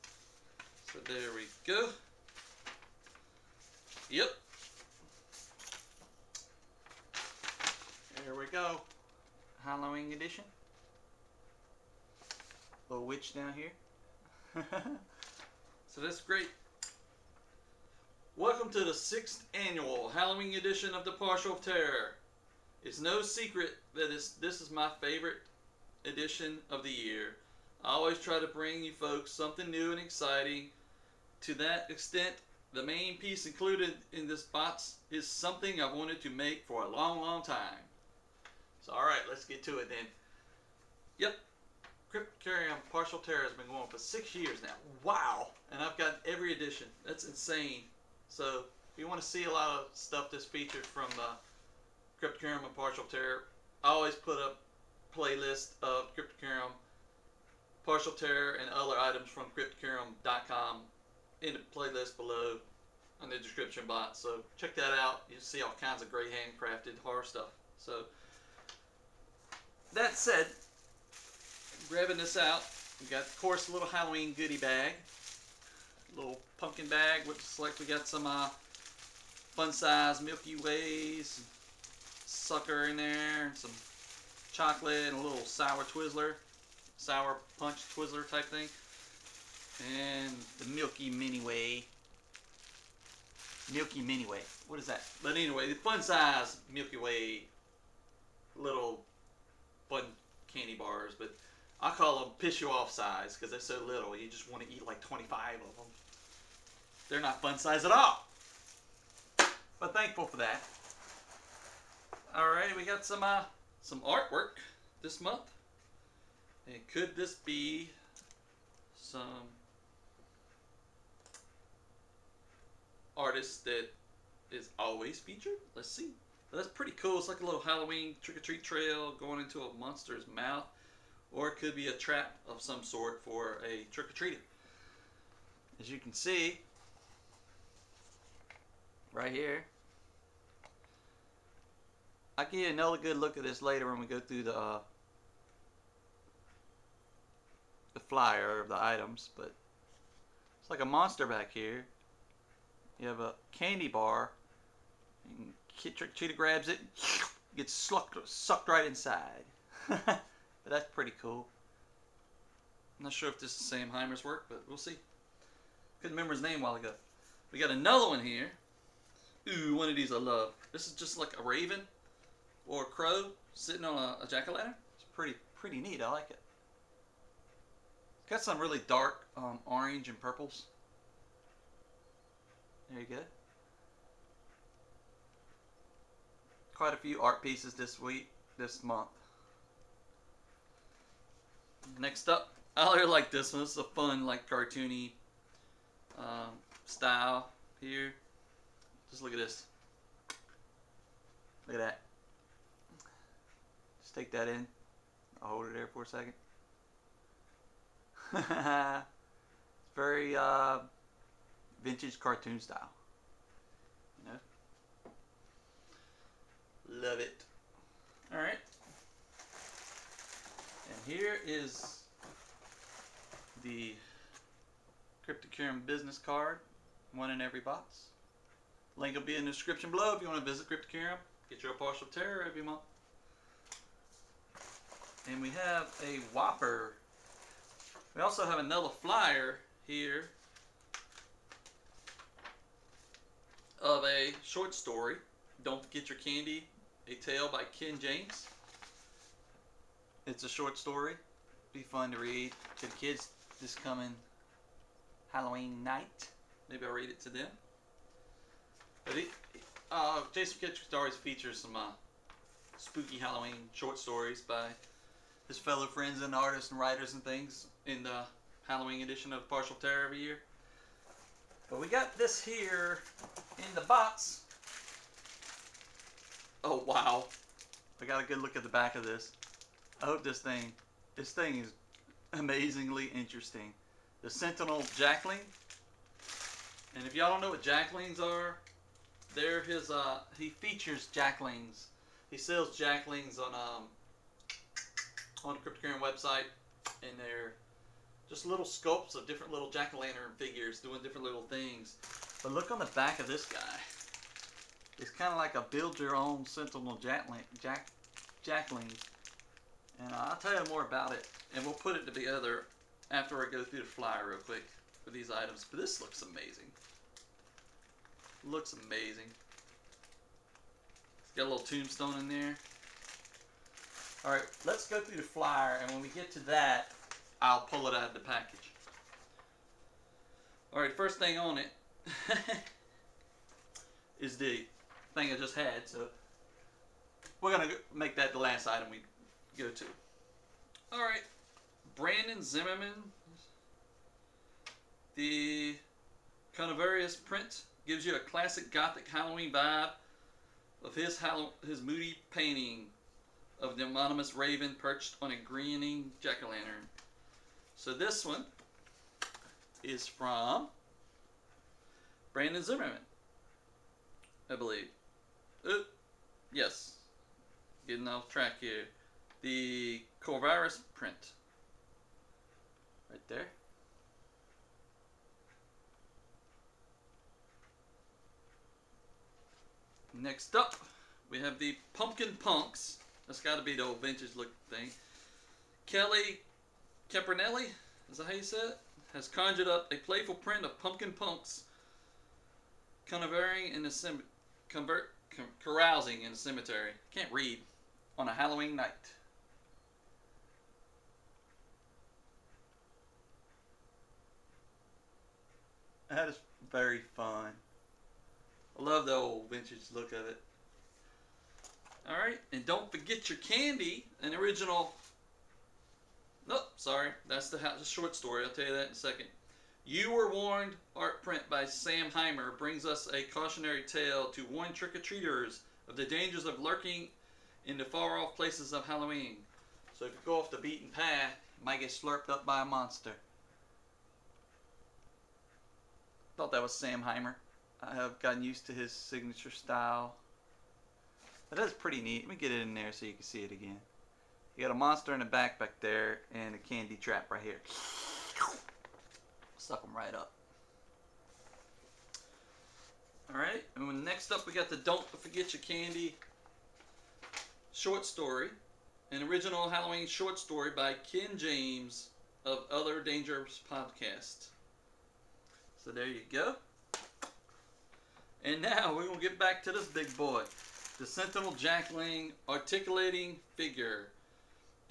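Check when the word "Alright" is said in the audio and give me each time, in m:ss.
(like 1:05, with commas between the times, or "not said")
5:24, 5:30, 6:52, 7:33.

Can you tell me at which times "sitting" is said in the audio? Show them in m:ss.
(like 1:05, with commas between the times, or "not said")
2:53.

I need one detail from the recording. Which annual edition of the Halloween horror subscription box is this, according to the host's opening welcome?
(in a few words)
6th.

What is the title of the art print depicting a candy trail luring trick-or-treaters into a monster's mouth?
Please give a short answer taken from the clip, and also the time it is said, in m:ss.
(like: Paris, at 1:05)
You Were Warned, at 6:59.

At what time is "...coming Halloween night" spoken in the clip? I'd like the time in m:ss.
4:13.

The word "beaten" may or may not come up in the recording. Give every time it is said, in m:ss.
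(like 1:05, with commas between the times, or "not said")
7:10.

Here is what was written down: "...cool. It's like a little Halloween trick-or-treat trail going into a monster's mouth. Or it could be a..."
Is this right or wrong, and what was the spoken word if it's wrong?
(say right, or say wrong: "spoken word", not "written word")
right.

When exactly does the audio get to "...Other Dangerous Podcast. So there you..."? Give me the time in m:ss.
7:42.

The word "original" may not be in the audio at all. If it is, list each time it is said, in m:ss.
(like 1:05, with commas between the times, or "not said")
6:54, 7:39.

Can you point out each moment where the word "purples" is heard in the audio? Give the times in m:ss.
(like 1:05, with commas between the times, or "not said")
3:00.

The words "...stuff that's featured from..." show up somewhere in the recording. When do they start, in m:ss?
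0:49.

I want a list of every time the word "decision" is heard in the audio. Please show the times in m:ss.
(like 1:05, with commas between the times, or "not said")
not said.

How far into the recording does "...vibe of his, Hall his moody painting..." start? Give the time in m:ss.
5:49.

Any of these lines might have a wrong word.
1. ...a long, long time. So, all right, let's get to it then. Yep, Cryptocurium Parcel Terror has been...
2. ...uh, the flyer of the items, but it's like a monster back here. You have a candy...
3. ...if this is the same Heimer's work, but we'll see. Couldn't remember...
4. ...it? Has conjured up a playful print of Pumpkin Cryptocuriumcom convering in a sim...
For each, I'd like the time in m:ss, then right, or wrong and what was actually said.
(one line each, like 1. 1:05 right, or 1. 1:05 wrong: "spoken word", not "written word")
1. 0:36 right
2. 2:24 right
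3. 2:43 right
4. 6:28 wrong: "Punks", not "Cryptocuriumcom".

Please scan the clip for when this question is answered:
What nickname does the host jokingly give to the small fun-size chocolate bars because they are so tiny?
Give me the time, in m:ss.
1:42.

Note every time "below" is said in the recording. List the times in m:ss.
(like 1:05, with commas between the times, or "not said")
1:02, 3:49.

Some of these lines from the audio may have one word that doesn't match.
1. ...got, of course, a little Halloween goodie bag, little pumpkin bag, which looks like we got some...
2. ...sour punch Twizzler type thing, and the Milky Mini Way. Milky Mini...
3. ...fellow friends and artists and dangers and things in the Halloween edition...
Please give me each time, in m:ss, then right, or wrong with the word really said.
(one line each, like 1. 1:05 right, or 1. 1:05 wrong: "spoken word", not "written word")
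1. 1:13 right
2. 1:26 right
3. 4:25 wrong: "writers", not "dangers".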